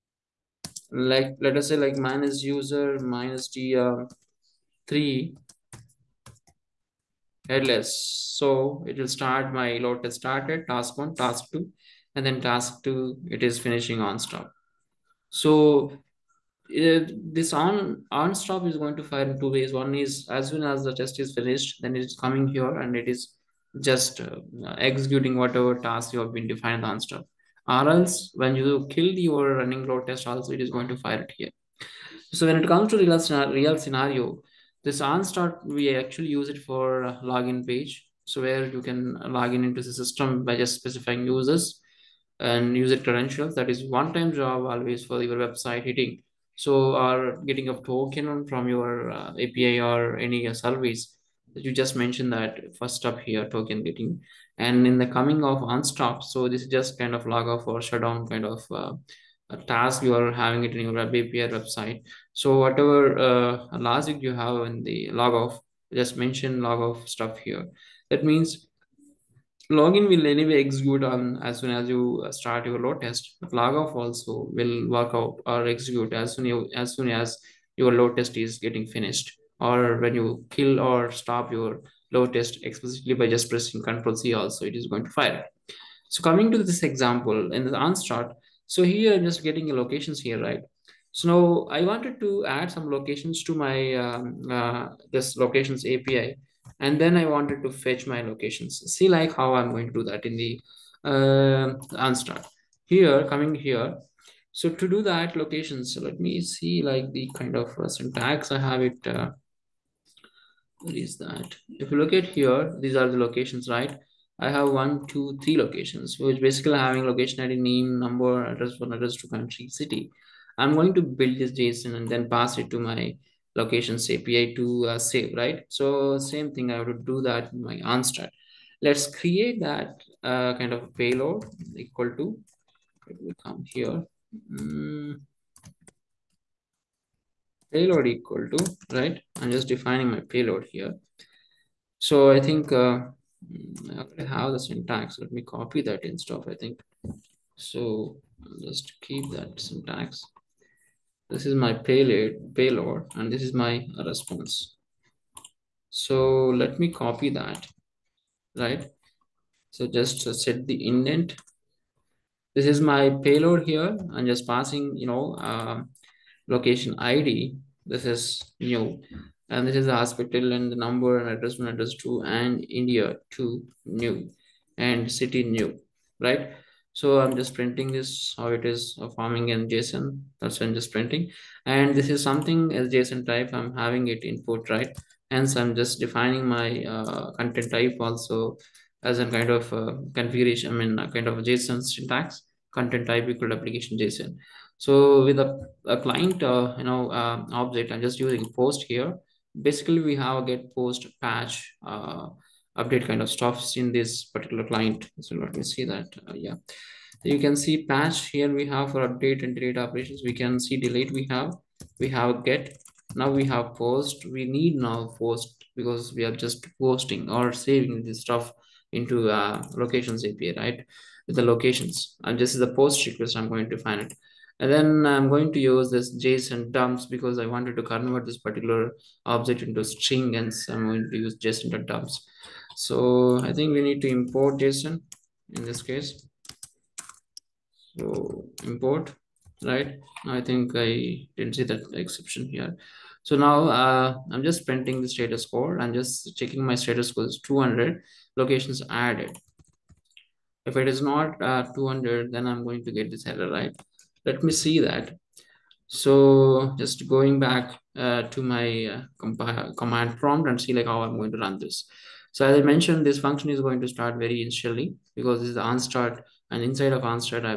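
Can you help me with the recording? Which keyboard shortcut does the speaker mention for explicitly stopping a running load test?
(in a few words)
Control C.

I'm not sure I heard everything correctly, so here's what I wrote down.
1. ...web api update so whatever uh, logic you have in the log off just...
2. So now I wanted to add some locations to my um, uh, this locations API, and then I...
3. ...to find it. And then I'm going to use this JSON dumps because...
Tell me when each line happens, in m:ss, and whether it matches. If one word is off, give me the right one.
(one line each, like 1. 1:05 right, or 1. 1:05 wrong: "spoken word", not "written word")
1. 1:00 wrong: "website", not "update"
2. 1:31 right
3. 3:43 right.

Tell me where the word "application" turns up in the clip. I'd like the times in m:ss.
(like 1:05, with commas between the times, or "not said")
3:13.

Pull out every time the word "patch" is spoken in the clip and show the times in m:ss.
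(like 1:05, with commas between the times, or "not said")
3:21, 3:27.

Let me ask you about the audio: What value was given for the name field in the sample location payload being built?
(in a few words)
hospital.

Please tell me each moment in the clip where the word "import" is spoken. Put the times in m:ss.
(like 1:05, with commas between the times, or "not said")
3:54, 3:58.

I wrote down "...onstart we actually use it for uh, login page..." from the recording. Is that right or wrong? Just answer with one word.
right.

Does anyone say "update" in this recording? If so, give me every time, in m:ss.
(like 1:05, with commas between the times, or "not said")
3:22, 3:29.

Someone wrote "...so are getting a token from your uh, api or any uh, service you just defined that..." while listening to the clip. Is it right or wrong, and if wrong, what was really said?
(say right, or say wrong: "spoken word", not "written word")
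wrong: "mentioned", not "defined".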